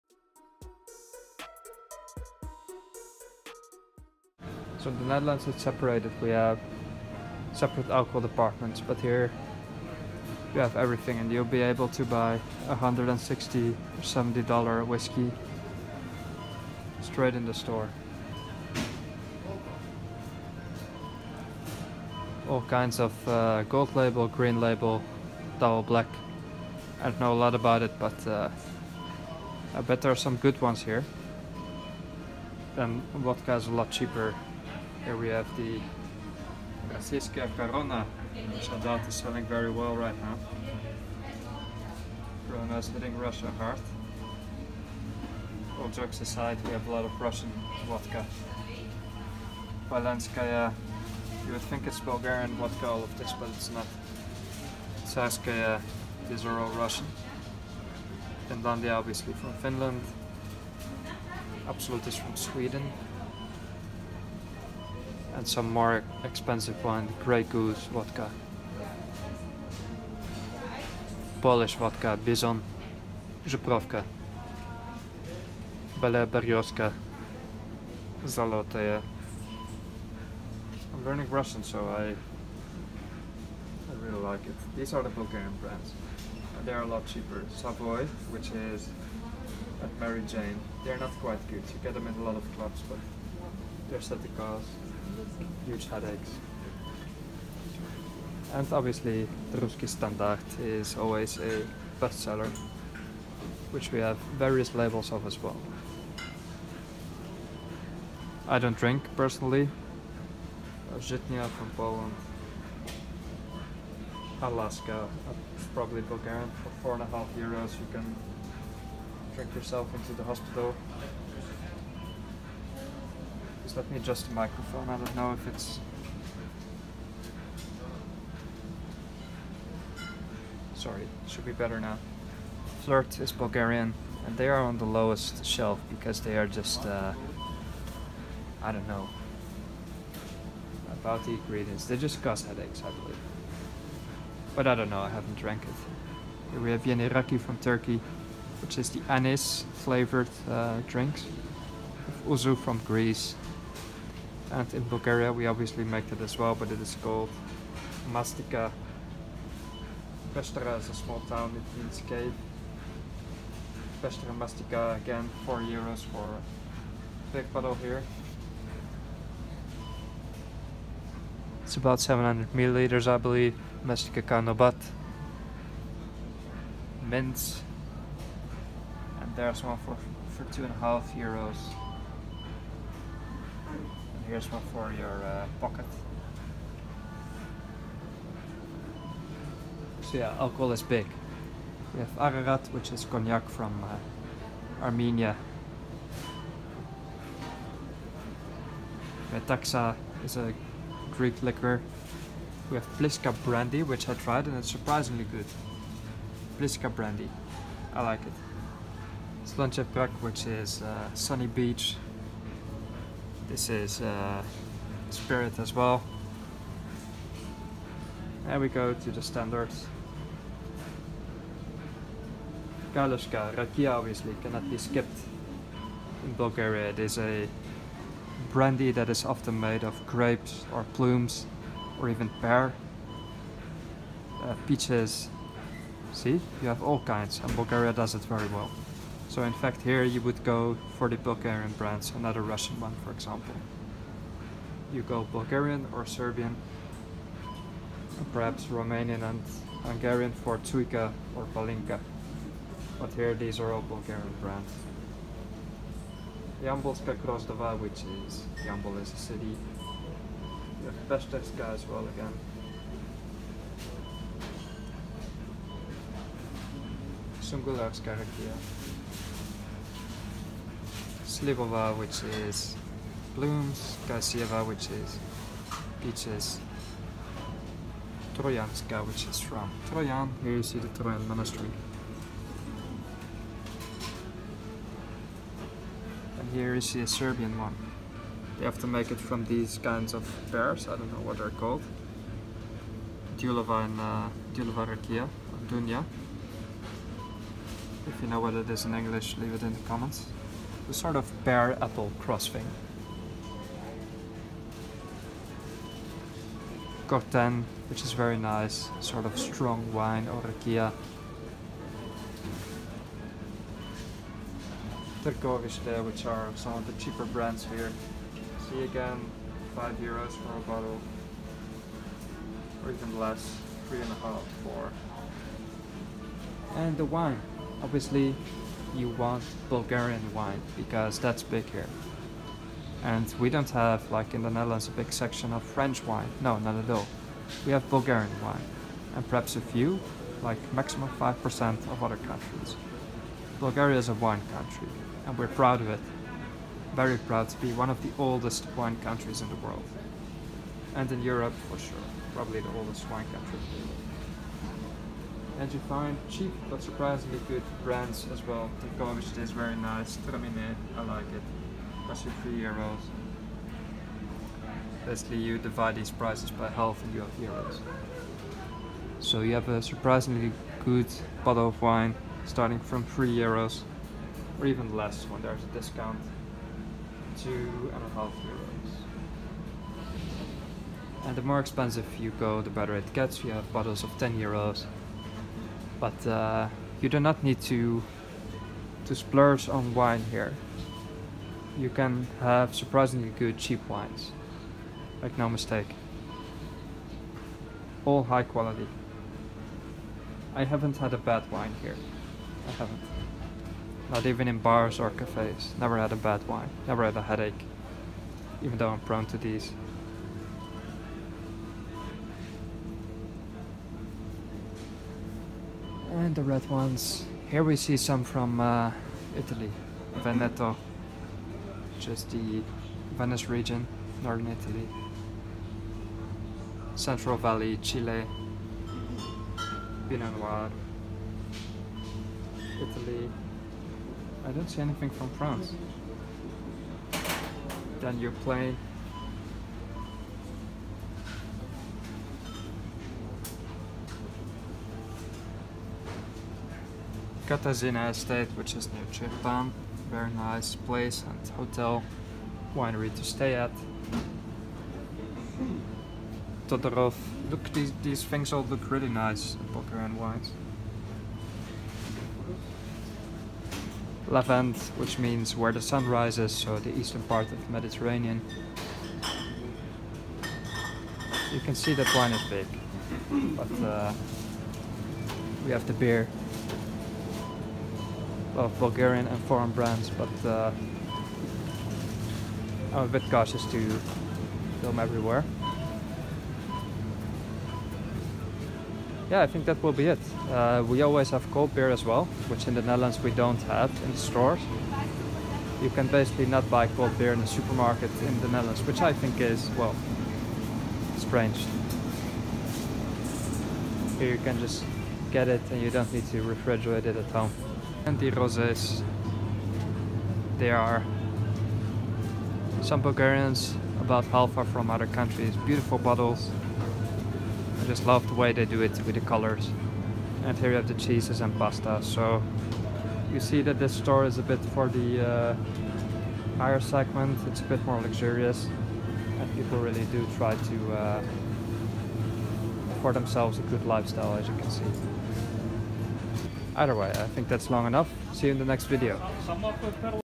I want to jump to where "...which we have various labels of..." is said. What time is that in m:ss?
1:43.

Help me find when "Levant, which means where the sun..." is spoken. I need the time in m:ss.
7:44.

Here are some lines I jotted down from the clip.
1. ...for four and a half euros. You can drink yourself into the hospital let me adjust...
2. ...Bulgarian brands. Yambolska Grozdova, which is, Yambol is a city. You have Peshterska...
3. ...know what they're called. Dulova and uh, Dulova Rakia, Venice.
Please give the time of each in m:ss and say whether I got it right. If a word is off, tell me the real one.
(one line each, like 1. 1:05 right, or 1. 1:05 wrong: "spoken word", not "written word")
1. 1:56 right
2. 4:13 right
3. 4:51 wrong: "Dunya", not "Venice".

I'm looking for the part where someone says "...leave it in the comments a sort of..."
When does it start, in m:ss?
4:59.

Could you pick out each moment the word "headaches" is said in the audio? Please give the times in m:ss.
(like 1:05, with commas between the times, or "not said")
1:35, 2:22, 6:47.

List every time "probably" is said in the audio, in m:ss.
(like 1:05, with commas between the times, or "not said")
1:55, 5:52.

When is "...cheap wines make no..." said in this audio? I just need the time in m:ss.
6:33.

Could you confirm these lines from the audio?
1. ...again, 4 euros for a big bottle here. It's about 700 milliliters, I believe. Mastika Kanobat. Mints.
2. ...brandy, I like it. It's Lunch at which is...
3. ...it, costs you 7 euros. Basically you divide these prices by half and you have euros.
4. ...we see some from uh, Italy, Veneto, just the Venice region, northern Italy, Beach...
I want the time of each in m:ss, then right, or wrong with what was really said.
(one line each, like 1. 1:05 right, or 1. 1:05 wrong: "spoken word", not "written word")
1. 2:44 right
2. 3:26 right
3. 6:01 wrong: "3", not "7"
4. 6:57 wrong: "Central", not "Beach".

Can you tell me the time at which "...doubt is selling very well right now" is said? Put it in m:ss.
0:38.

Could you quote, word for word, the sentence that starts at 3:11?
We have Ararat, which is cognac from uh, Armenia.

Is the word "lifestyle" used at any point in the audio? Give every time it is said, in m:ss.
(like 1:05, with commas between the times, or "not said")
8:53.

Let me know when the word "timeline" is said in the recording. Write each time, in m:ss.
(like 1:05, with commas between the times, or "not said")
not said.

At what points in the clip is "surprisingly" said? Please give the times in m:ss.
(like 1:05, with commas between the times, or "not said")
3:24, 5:56, 6:09, 6:32.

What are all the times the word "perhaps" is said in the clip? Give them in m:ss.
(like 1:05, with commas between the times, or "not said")
4:08, 5:39.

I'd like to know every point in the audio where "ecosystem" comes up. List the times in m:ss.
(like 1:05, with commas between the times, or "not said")
not said.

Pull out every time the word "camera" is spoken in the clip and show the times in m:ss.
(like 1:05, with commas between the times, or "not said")
not said.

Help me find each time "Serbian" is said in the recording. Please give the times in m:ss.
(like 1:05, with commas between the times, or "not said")
4:06, 4:47.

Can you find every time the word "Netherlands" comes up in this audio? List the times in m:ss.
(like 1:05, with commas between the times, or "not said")
0:05, 5:34, 8:12, 8:18.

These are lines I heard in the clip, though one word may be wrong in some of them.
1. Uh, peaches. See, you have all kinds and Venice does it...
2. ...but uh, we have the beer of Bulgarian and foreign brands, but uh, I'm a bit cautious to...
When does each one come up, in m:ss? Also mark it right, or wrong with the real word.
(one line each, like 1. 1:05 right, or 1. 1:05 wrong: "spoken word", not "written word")
1. 3:54 wrong: "Bulgaria", not "Venice"
2. 7:53 right.